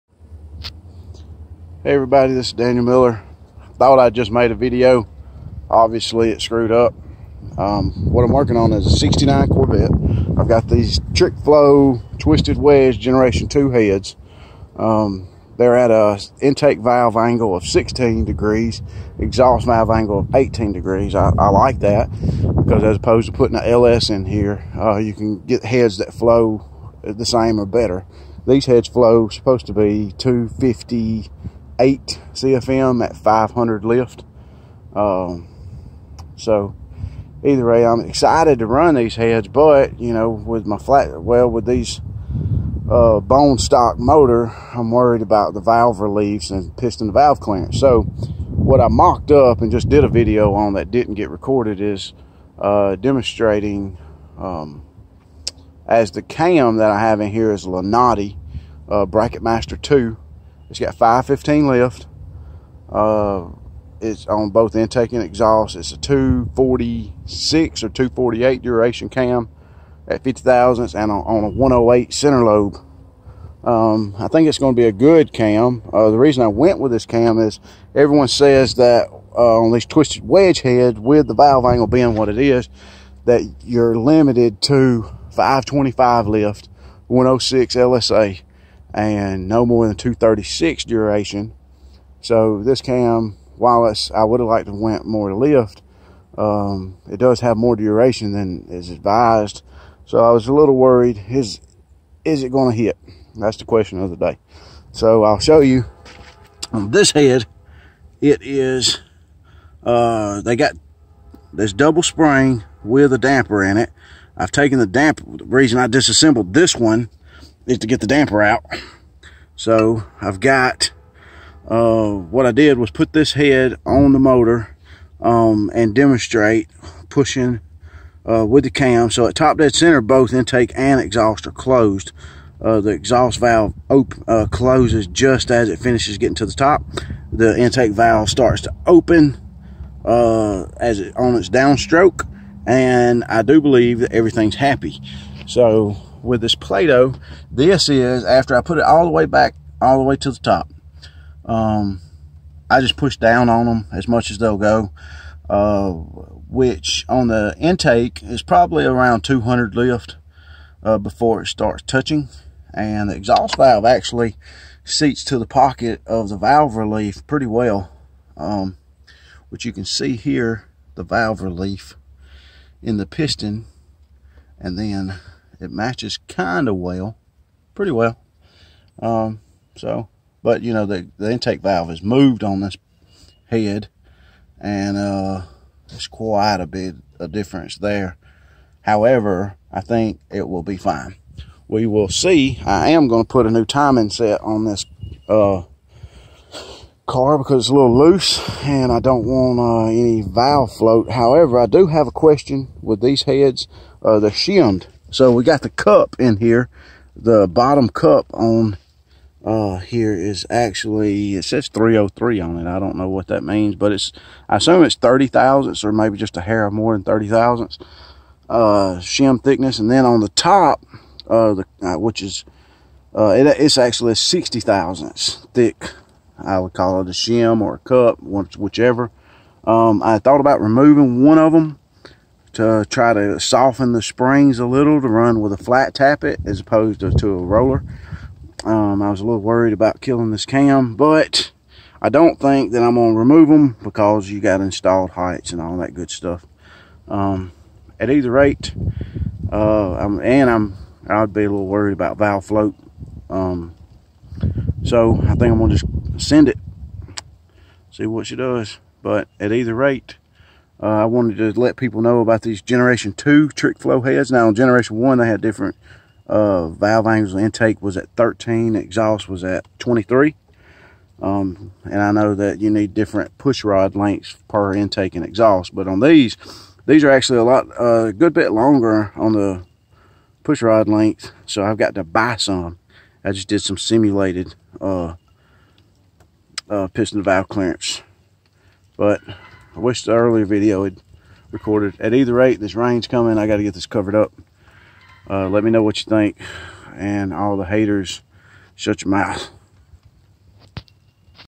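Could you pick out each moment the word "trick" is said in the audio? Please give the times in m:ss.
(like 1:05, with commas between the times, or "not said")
0:11, 4:23.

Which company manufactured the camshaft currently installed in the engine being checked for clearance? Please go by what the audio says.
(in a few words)
Lunati.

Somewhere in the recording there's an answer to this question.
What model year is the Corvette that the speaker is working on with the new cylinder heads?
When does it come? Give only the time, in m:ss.
0:08.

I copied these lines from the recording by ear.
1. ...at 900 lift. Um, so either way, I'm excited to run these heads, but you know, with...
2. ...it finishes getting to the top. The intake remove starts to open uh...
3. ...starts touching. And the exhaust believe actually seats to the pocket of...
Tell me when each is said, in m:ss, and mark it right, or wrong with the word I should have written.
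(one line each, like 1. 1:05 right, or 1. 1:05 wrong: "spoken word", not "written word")
1. 0:33 wrong: "500", not "900"
2. 2:15 wrong: "valve", not "remove"
3. 2:41 wrong: "valve", not "believe".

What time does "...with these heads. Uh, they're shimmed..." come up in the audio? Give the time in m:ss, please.
3:22.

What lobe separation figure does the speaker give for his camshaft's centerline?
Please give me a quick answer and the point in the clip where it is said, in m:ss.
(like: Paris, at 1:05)
108, at 1:11.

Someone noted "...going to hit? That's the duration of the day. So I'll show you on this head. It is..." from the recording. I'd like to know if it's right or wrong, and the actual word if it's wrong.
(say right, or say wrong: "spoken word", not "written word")
wrong: "question", not "duration".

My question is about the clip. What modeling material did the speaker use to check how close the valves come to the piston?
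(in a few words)
Play-Doh.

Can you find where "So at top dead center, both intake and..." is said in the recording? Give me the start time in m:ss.
2:09.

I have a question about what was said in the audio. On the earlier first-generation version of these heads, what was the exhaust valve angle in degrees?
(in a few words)
23.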